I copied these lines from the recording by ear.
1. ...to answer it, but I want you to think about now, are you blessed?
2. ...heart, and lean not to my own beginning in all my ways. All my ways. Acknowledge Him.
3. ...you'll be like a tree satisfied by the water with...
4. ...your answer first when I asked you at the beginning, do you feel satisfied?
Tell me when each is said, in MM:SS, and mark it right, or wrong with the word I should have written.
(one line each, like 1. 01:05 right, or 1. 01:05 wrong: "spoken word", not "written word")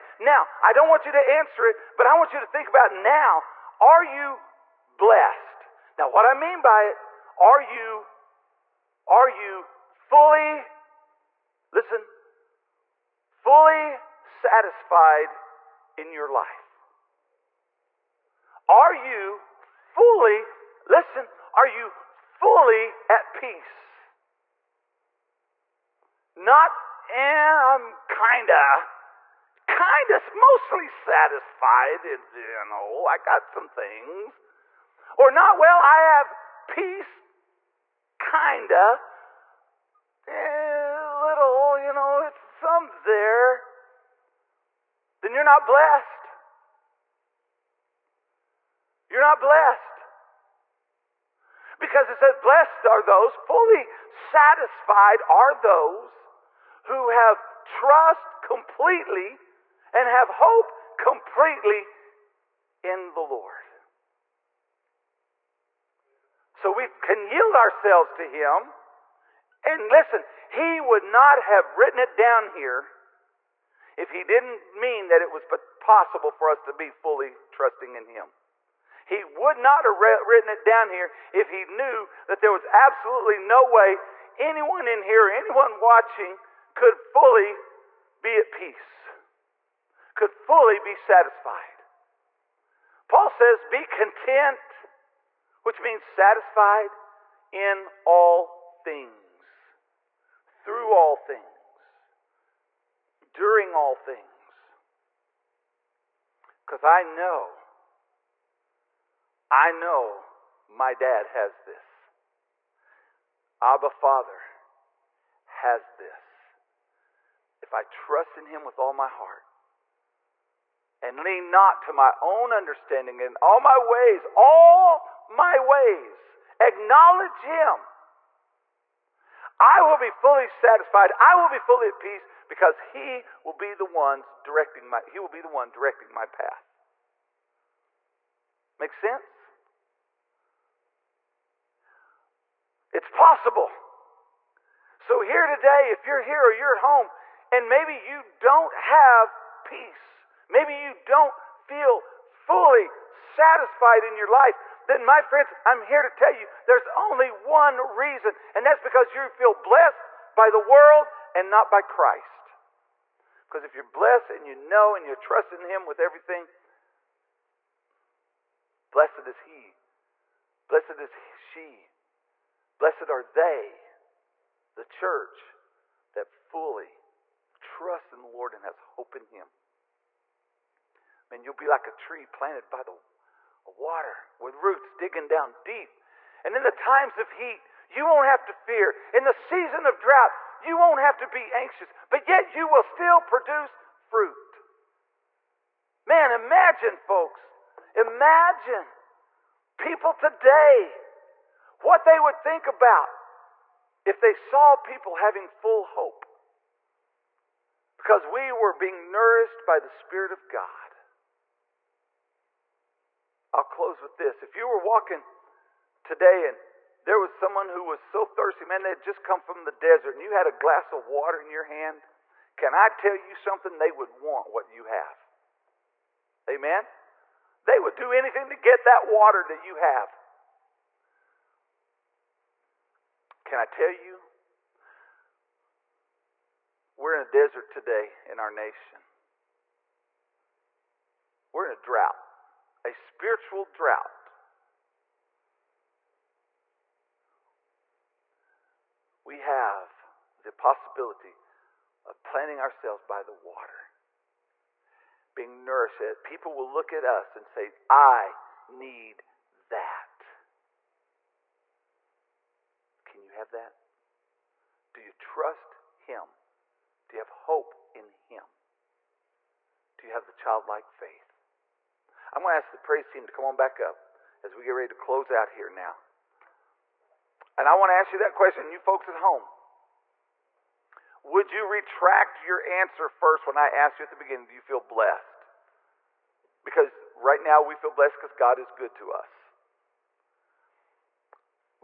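1. 00:01 right
2. 01:59 wrong: "understanding", not "beginning"
3. 03:01 wrong: "planted", not "satisfied"
4. 04:42 wrong: "blessed", not "satisfied".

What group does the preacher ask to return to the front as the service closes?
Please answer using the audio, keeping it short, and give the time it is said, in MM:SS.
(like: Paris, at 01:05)
The praise team, at 04:32.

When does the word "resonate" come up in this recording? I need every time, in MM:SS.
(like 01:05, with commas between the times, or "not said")
not said.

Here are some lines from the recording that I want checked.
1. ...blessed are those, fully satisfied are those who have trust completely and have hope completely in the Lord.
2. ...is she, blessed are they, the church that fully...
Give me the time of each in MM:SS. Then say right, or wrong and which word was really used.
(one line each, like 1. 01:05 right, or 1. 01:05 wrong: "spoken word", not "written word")
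1. 00:52 right
2. 02:51 right.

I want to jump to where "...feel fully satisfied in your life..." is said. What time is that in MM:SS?
02:31.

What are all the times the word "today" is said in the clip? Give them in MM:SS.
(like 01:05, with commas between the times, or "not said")
02:25, 03:20, 03:36, 03:57.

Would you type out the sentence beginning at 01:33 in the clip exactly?
Paul says, be content which means satisfied in all things, through all things, during all things.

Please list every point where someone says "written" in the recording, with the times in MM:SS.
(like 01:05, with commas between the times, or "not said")
01:11, 01:20.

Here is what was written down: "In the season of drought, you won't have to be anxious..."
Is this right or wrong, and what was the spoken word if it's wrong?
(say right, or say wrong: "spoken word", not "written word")
right.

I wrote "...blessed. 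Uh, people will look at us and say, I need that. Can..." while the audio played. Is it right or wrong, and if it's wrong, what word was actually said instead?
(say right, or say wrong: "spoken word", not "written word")
wrong: "nourished", not "blessed".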